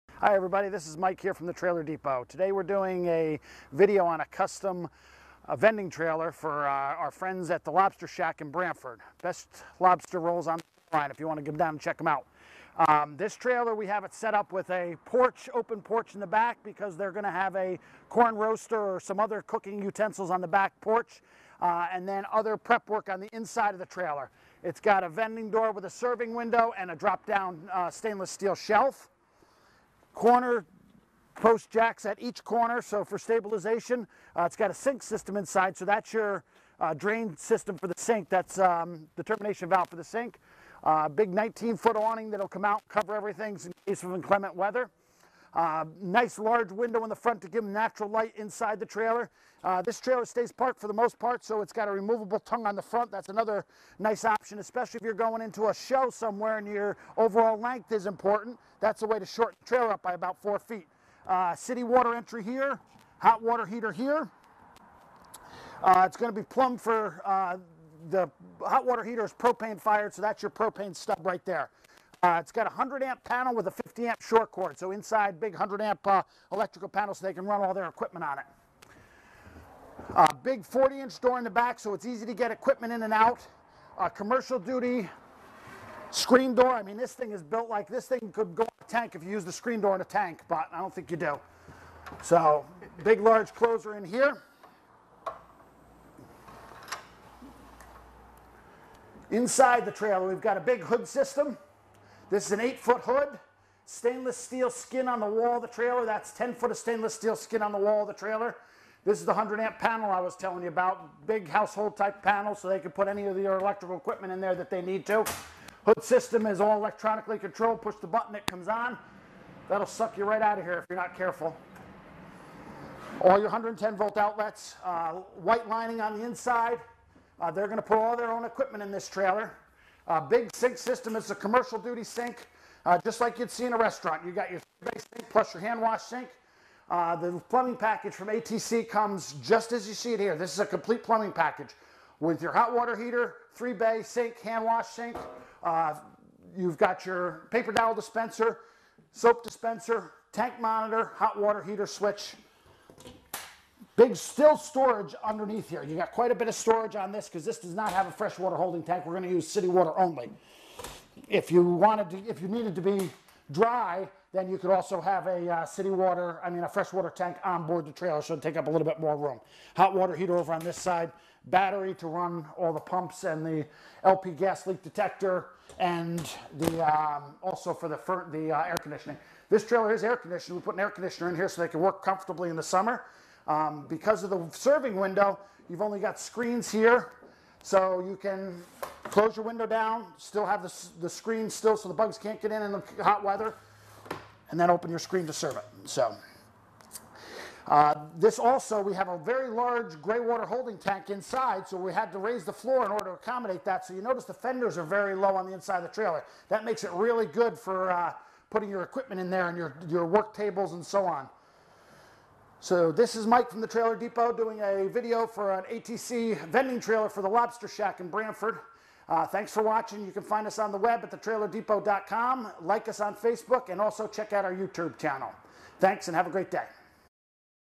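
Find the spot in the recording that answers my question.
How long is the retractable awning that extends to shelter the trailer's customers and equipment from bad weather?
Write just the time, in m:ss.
0:41.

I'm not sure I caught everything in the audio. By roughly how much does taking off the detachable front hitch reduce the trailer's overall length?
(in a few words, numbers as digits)
4 feet.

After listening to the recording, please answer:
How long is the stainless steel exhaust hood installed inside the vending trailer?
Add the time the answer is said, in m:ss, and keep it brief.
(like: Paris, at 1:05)
8 feet, at 1:42.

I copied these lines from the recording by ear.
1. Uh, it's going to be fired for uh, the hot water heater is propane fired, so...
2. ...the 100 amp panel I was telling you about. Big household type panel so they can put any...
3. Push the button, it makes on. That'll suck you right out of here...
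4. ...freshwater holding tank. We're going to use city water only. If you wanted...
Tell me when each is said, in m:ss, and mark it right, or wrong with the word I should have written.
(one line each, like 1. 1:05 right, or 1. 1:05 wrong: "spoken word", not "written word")
1. 1:05 wrong: "plumbed", not "fired"
2. 1:49 right
3. 1:57 wrong: "comes", not "makes"
4. 2:38 right.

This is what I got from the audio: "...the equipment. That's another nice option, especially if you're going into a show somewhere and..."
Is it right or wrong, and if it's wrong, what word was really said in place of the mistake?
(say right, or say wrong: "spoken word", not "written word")
wrong: "front", not "equipment".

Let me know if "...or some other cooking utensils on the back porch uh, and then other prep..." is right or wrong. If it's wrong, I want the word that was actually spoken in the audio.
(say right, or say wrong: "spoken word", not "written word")
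right.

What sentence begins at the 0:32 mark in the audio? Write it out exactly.
So for stabilization, uh, it's got a sink system inside.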